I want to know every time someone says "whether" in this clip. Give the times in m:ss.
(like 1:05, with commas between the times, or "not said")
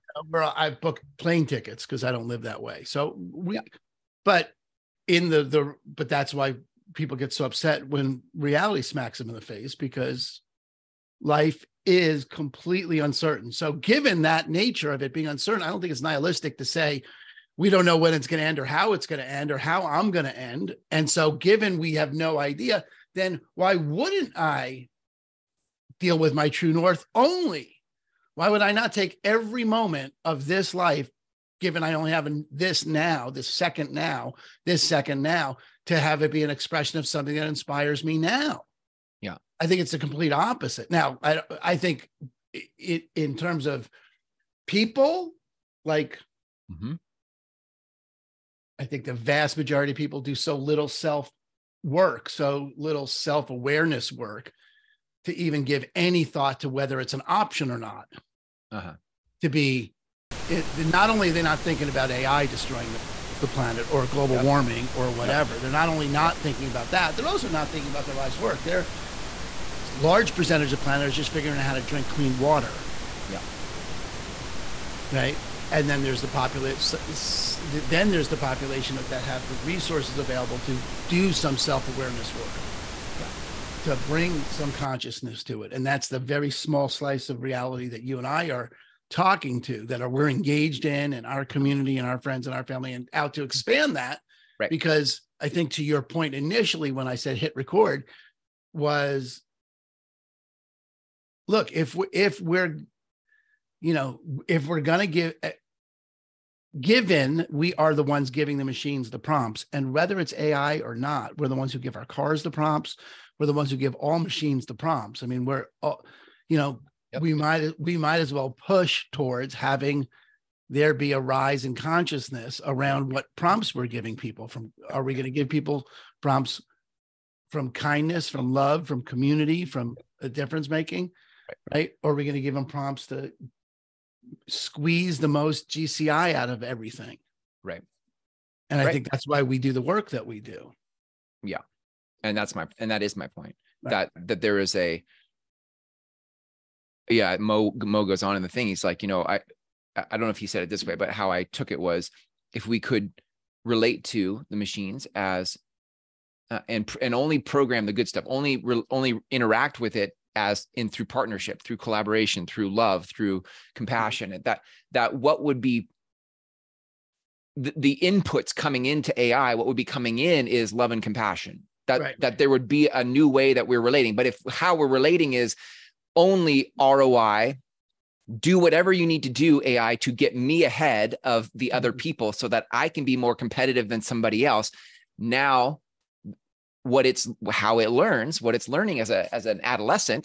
0:56, 1:49.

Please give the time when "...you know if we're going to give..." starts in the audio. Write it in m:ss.
1:43.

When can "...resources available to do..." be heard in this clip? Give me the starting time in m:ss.
1:19.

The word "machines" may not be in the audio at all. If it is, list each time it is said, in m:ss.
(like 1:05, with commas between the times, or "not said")
1:48, 1:54, 2:34.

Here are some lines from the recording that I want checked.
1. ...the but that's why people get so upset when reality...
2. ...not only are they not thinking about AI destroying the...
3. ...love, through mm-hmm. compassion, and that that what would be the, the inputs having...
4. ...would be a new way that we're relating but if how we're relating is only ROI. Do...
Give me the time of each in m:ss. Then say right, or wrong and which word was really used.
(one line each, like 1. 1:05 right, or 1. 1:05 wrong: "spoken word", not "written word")
1. 0:05 right
2. 1:00 right
3. 2:42 wrong: "coming", not "having"
4. 2:52 right.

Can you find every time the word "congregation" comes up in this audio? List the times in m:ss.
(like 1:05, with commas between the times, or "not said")
not said.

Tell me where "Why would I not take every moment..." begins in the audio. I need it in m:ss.
0:28.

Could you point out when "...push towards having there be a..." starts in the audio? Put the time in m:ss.
1:58.